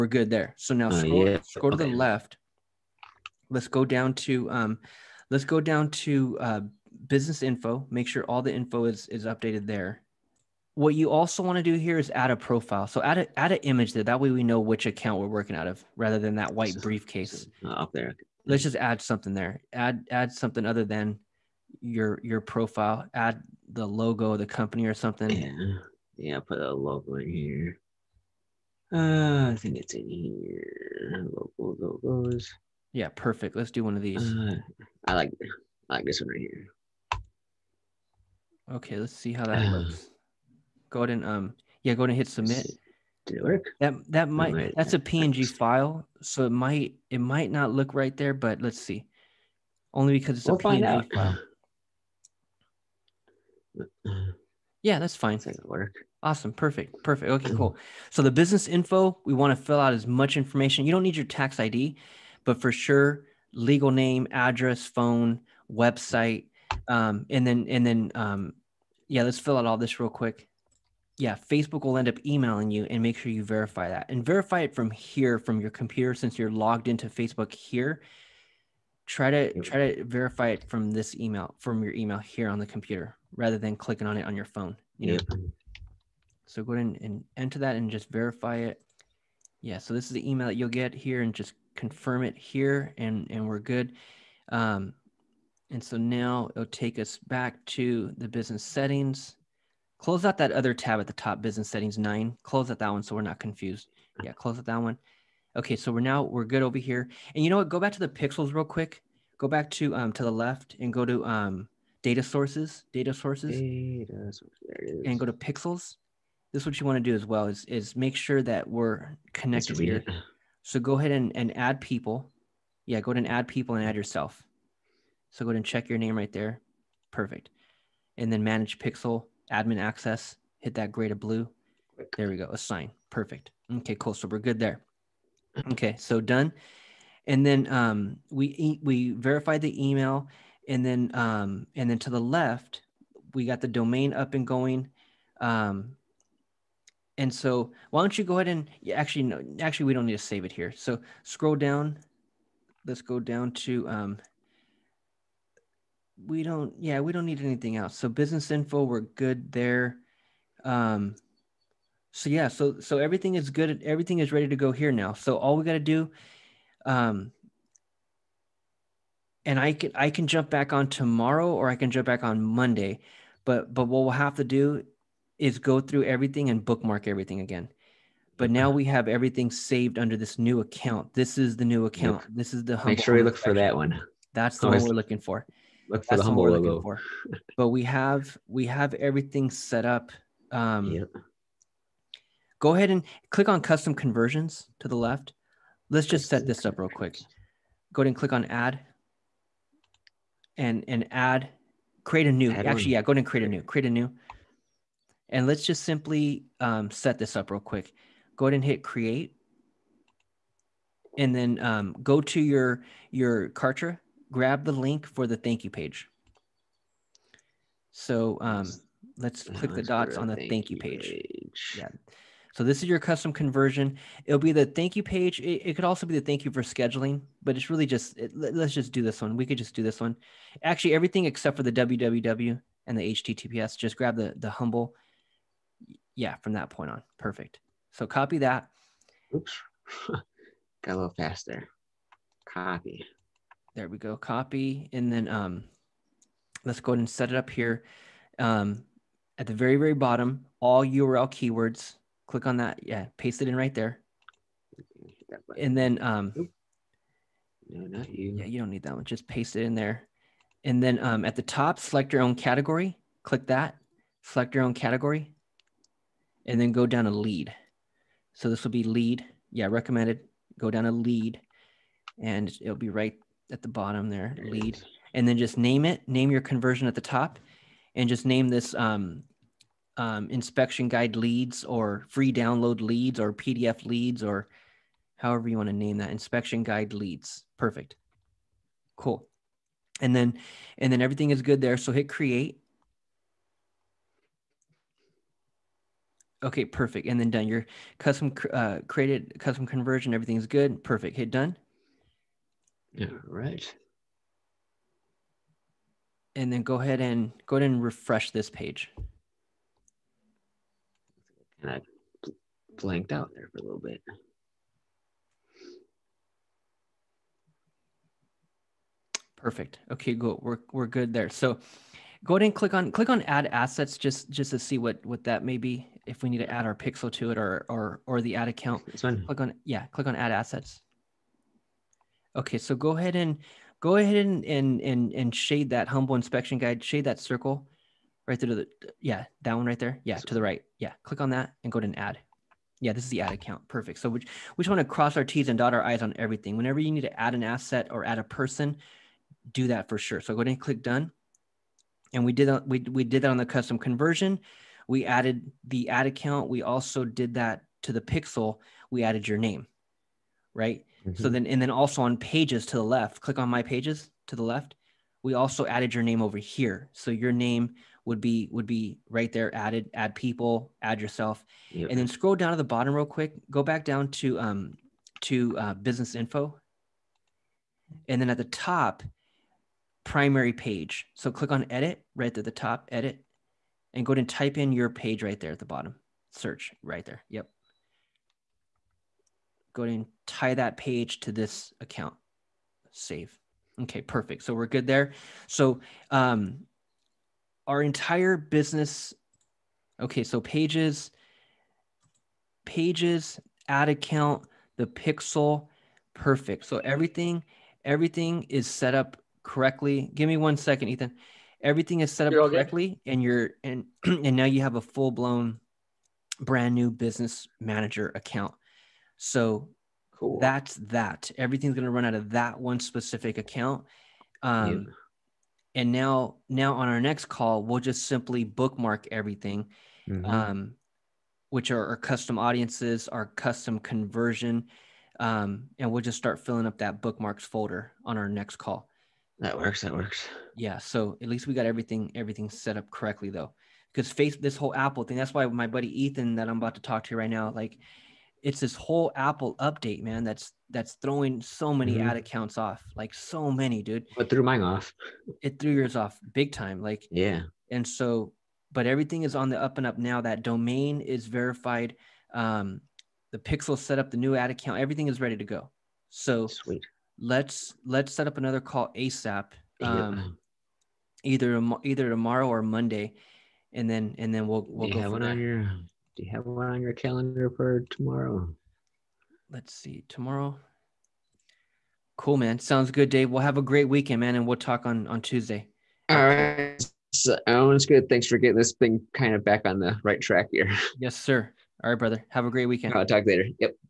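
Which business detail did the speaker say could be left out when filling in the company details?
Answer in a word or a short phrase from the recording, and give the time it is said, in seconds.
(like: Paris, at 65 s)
tax ID, at 61 s.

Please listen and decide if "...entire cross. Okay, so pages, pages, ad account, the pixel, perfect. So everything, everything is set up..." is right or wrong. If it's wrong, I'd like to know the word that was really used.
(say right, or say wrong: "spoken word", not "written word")
wrong: "business", not "cross".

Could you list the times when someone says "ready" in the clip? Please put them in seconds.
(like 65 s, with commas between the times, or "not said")
164 s, 465 s.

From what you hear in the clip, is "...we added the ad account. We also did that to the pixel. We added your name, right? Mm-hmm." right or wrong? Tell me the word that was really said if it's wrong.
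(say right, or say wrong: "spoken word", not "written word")
right.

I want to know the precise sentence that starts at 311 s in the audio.
And I blanked out there for a little bit.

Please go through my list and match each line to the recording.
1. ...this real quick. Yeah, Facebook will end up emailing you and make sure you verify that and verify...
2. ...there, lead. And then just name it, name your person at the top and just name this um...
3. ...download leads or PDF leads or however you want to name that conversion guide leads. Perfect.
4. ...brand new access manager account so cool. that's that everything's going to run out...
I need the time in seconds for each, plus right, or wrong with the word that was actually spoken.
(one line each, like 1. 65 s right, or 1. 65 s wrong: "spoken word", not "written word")
1. 69 s right
2. 274 s wrong: "conversion", not "person"
3. 282 s wrong: "inspection", not "conversion"
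4. 416 s wrong: "business", not "access".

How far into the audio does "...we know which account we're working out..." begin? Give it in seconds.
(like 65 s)
14 s.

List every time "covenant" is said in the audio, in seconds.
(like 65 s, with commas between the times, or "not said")
not said.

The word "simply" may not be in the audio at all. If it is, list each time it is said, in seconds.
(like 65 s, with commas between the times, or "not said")
205 s, 428 s.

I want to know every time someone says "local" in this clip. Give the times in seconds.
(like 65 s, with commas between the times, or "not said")
not said.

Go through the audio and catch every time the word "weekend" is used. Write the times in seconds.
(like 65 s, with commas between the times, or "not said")
483 s, 492 s.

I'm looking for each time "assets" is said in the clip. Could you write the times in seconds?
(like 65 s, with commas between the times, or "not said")
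323 s, 330 s, 347 s.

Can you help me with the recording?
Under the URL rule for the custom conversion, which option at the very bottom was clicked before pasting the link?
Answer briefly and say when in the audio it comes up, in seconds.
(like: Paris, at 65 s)
URL keywords, at 250 s.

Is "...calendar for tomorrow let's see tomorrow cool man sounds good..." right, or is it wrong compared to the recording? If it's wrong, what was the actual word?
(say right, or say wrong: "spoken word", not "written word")
right.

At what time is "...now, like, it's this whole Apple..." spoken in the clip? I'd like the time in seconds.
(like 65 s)
447 s.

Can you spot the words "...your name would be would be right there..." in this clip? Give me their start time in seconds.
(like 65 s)
367 s.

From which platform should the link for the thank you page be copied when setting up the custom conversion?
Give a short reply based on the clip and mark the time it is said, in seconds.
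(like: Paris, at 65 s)
Kartra, at 213 s.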